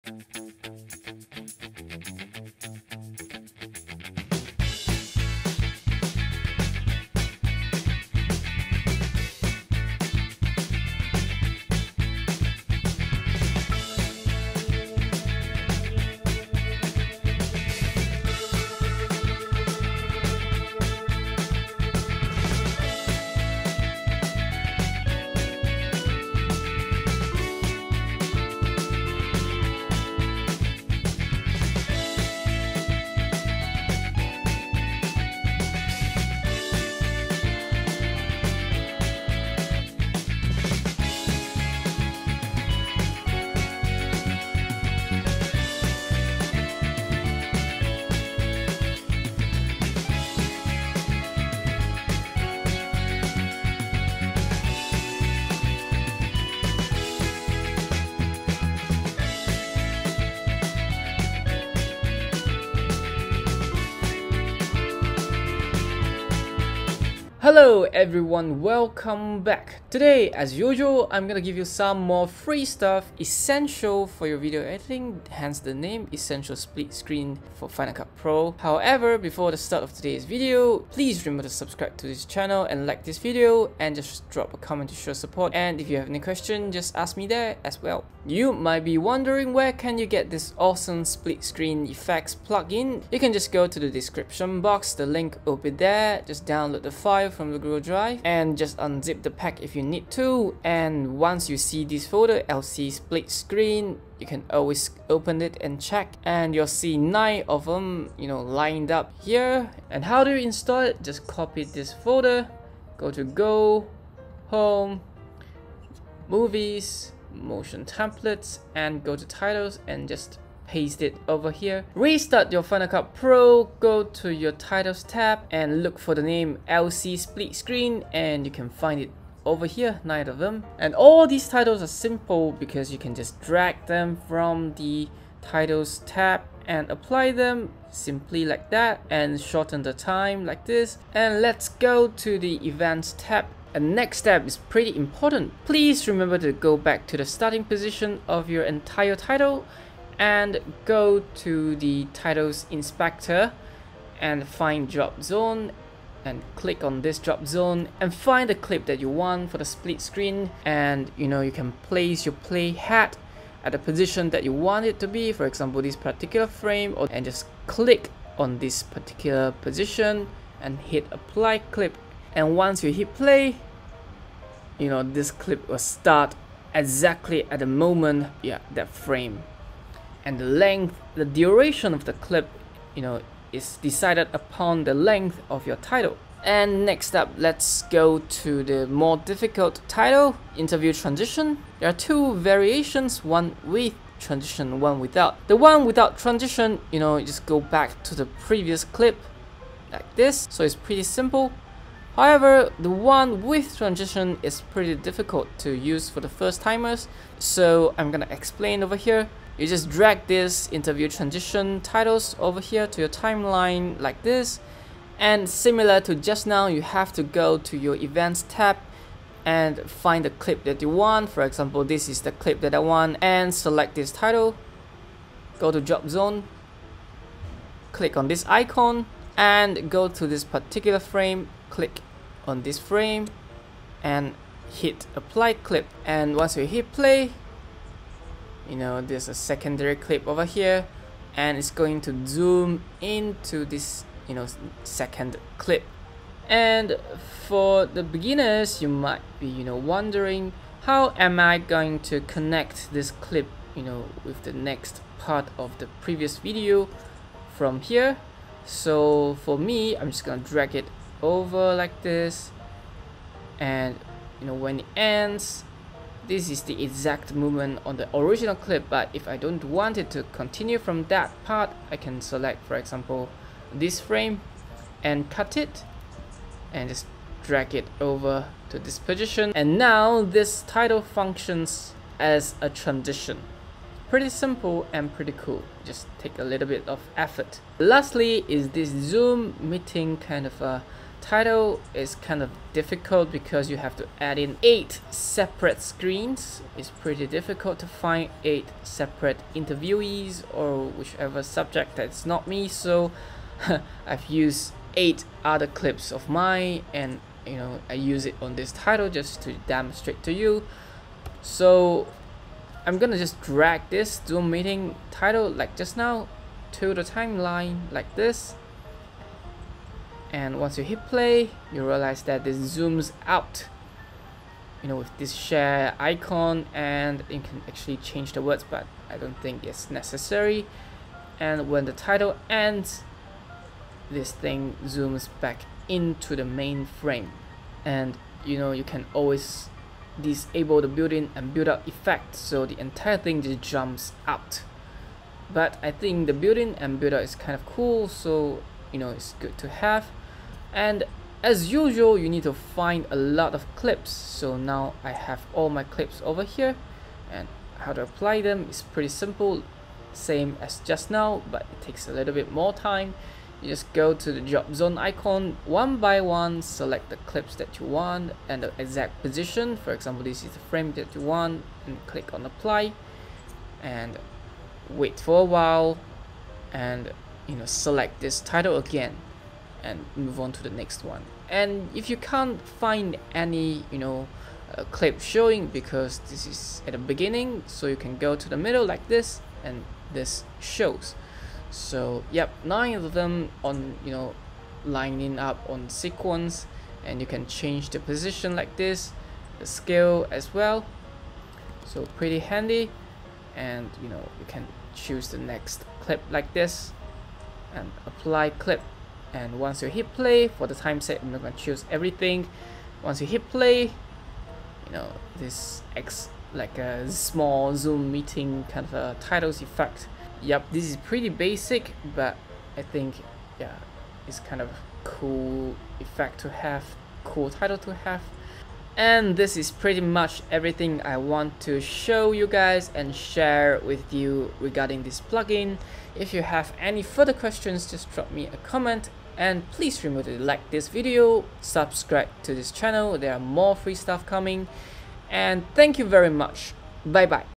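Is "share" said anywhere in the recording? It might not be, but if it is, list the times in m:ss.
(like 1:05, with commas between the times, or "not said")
5:25, 7:13.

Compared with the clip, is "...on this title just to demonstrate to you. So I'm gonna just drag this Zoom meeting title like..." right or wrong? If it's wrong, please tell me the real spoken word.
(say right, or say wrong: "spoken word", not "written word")
right.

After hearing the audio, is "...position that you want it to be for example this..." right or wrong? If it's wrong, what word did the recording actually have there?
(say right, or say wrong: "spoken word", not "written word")
right.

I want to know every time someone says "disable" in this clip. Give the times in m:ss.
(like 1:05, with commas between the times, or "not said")
5:40.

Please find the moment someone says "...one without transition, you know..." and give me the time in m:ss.
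3:15.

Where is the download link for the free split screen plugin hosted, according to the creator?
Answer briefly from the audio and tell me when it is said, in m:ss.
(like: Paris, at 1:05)
Google Drive, at 1:37.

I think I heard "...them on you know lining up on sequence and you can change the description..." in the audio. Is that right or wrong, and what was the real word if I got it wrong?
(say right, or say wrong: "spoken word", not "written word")
wrong: "position", not "description".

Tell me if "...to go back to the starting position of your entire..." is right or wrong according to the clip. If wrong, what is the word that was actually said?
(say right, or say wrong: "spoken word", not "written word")
right.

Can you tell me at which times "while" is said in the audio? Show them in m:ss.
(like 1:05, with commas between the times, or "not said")
6:15.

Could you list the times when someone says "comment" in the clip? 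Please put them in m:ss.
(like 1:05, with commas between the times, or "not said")
1:24, 7:18.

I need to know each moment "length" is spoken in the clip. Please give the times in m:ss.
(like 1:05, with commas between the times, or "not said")
3:00, 3:04.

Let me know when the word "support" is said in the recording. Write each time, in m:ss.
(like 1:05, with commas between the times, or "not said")
1:25.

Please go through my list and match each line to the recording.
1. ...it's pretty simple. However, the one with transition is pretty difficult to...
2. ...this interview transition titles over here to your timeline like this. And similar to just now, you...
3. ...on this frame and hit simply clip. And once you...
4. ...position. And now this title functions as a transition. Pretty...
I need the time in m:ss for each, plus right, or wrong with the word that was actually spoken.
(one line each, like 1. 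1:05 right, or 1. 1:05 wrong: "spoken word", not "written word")
1. 3:20 right
2. 3:30 right
3. 3:52 wrong: "apply", not "simply"
4. 4:38 right.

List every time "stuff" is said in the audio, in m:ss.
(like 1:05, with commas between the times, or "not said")
1:12, 7:23.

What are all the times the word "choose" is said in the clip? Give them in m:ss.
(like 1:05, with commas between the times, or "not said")
6:44, 6:51.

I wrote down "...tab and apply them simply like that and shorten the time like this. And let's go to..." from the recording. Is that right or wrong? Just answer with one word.
right.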